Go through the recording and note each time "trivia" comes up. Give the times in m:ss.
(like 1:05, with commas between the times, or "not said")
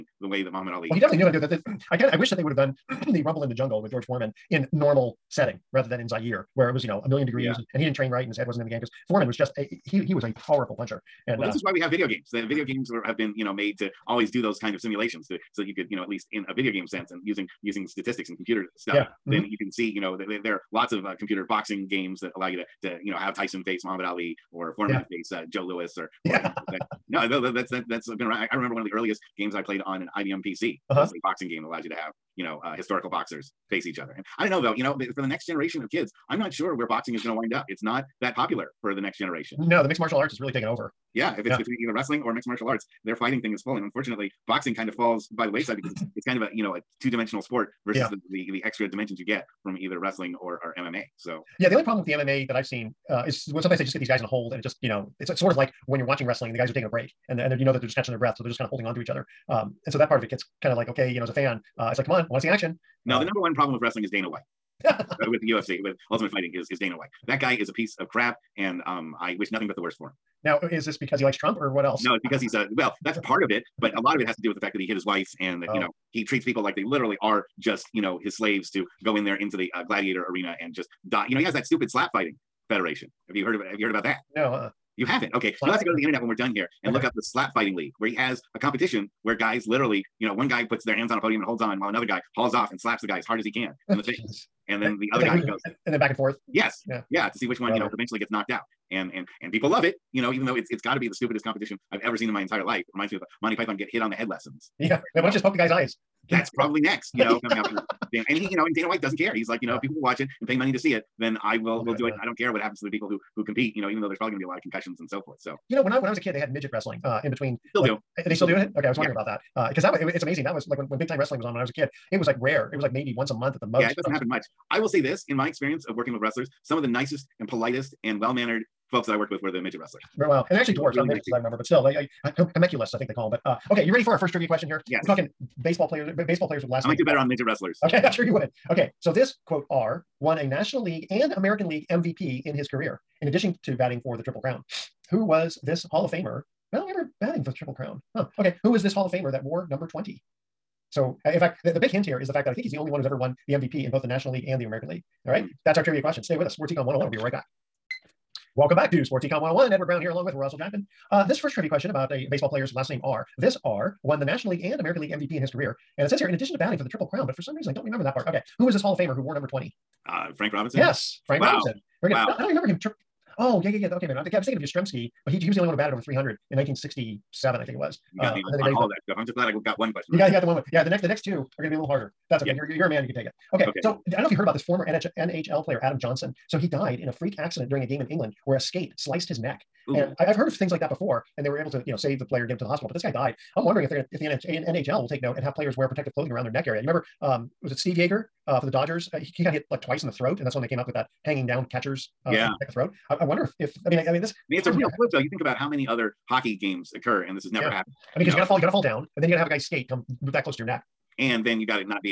2:14, 2:35, 2:41.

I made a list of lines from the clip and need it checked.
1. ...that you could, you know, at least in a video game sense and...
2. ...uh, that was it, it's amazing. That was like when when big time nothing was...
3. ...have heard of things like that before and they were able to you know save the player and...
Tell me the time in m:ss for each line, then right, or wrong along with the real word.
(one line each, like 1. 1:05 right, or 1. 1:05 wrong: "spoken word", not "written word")
1. 0:15 right
2. 1:59 wrong: "wrestling", not "nothing"
3. 3:10 right.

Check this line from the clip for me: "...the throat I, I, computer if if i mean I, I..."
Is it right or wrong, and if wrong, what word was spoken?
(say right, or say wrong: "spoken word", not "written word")
wrong: "wonder", not "computer".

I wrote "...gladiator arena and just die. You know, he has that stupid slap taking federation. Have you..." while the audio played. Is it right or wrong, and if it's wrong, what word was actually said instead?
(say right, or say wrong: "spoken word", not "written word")
wrong: "fighting", not "taking".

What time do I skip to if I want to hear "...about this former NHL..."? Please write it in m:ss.
3:04.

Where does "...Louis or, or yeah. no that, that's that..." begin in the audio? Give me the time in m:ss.
0:25.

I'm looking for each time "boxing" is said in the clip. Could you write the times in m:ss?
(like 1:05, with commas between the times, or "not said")
0:21, 0:31, 0:36, 0:44.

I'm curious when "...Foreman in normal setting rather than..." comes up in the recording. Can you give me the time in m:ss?
0:04.